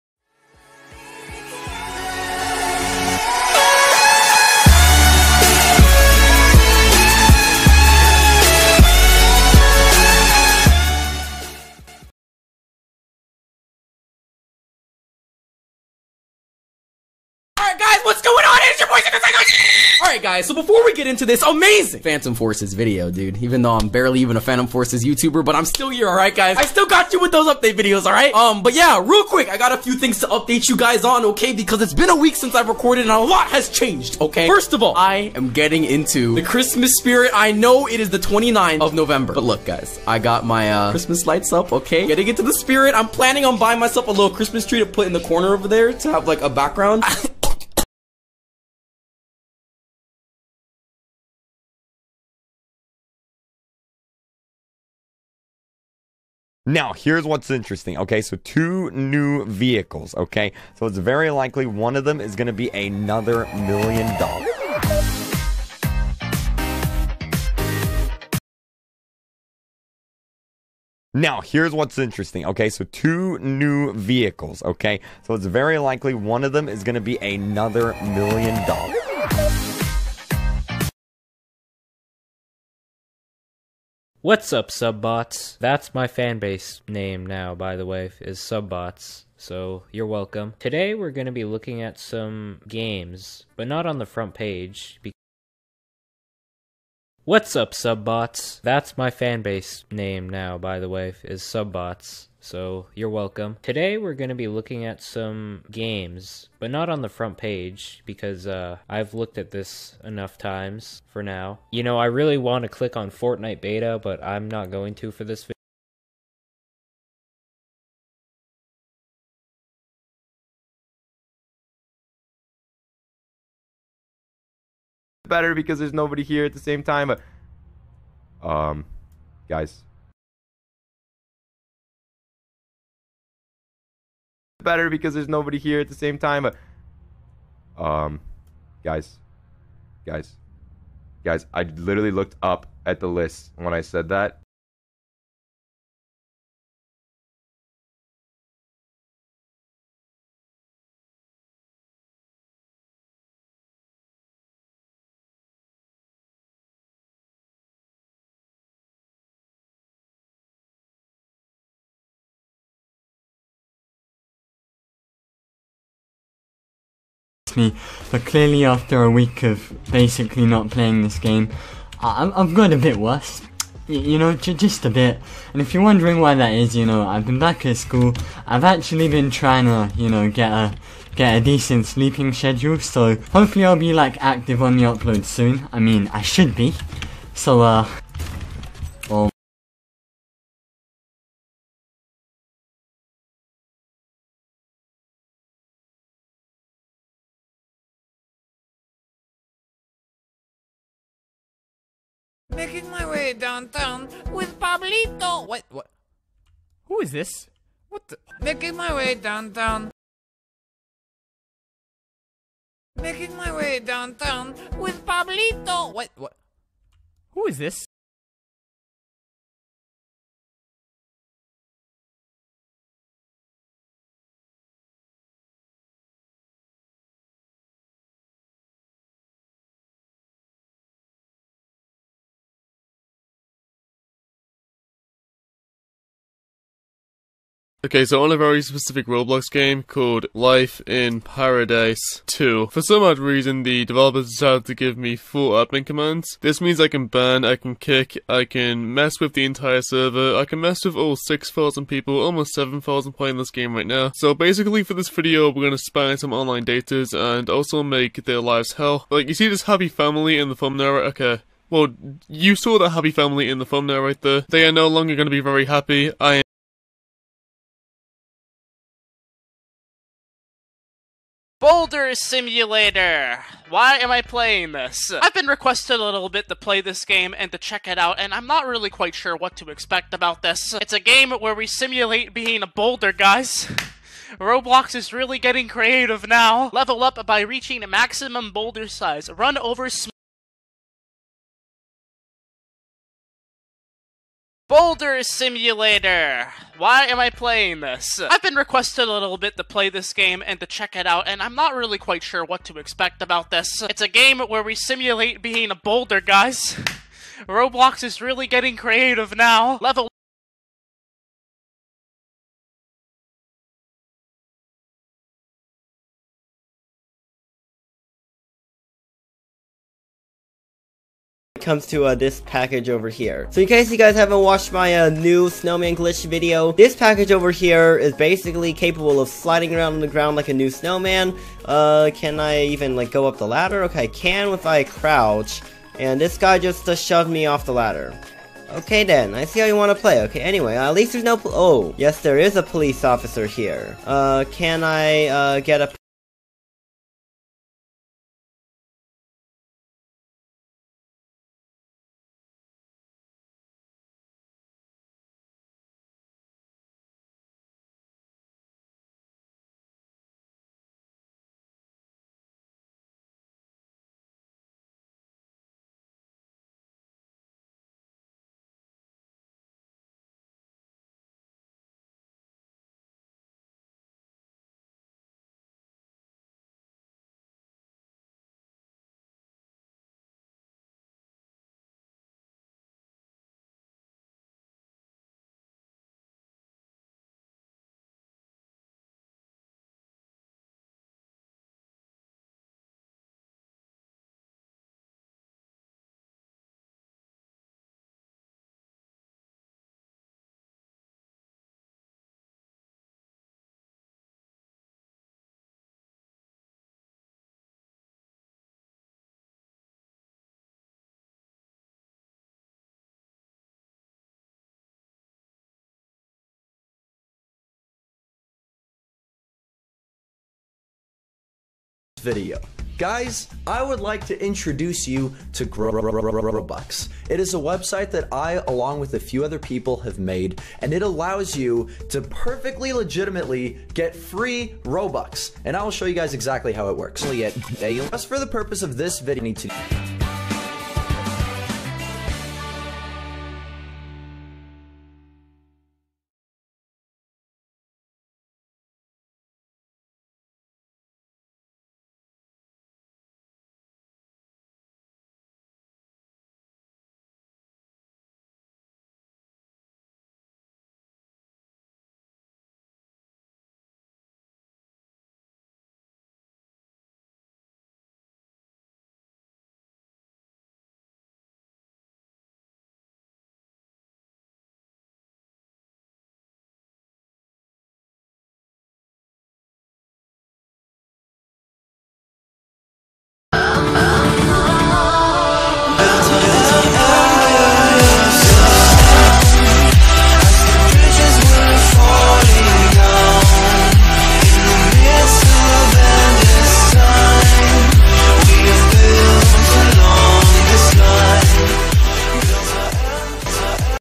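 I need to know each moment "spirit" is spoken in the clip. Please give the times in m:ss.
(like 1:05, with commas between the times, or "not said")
0:36, 0:42.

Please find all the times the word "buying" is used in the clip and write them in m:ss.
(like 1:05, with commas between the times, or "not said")
0:43.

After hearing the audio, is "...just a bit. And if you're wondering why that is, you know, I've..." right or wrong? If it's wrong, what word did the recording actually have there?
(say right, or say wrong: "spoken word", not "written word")
right.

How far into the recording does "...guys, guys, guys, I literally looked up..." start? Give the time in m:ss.
2:18.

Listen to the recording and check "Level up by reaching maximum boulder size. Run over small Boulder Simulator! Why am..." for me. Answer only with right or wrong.
right.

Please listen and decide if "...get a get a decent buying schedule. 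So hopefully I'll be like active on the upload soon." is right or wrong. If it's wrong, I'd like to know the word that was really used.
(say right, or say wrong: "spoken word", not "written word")
wrong: "sleeping", not "buying".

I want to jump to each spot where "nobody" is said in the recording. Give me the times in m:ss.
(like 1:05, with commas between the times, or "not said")
2:05, 2:15.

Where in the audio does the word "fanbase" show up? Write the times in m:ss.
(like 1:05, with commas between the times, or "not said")
1:26, 1:39.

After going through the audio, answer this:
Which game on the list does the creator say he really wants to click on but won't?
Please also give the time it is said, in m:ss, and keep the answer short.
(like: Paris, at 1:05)
Fortnite beta, at 1:53.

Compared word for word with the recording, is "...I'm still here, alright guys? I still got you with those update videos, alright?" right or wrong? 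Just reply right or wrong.
right.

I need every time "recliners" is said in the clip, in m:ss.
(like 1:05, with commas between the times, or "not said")
not said.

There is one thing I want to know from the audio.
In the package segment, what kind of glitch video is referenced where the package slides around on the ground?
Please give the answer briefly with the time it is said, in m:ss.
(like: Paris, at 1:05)
new snowman glitch, at 5:25.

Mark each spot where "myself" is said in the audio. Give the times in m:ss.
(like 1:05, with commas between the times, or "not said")
0:43.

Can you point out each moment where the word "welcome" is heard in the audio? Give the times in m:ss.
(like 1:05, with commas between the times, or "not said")
1:30, 1:43.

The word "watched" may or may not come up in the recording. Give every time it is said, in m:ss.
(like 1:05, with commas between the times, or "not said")
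5:24.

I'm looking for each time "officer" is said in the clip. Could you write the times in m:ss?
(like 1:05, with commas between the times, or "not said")
5:43.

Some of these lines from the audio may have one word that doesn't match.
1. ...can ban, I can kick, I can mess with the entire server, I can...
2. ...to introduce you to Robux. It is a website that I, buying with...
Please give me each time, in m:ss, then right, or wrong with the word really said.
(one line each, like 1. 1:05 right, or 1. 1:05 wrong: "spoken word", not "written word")
1. 4:06 right
2. 7:04 wrong: "along", not "buying".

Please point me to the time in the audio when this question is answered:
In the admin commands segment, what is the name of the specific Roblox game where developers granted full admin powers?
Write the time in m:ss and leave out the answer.
4:00.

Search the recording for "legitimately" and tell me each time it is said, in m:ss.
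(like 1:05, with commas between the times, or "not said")
7:12.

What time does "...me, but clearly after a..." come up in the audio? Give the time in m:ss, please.
2:47.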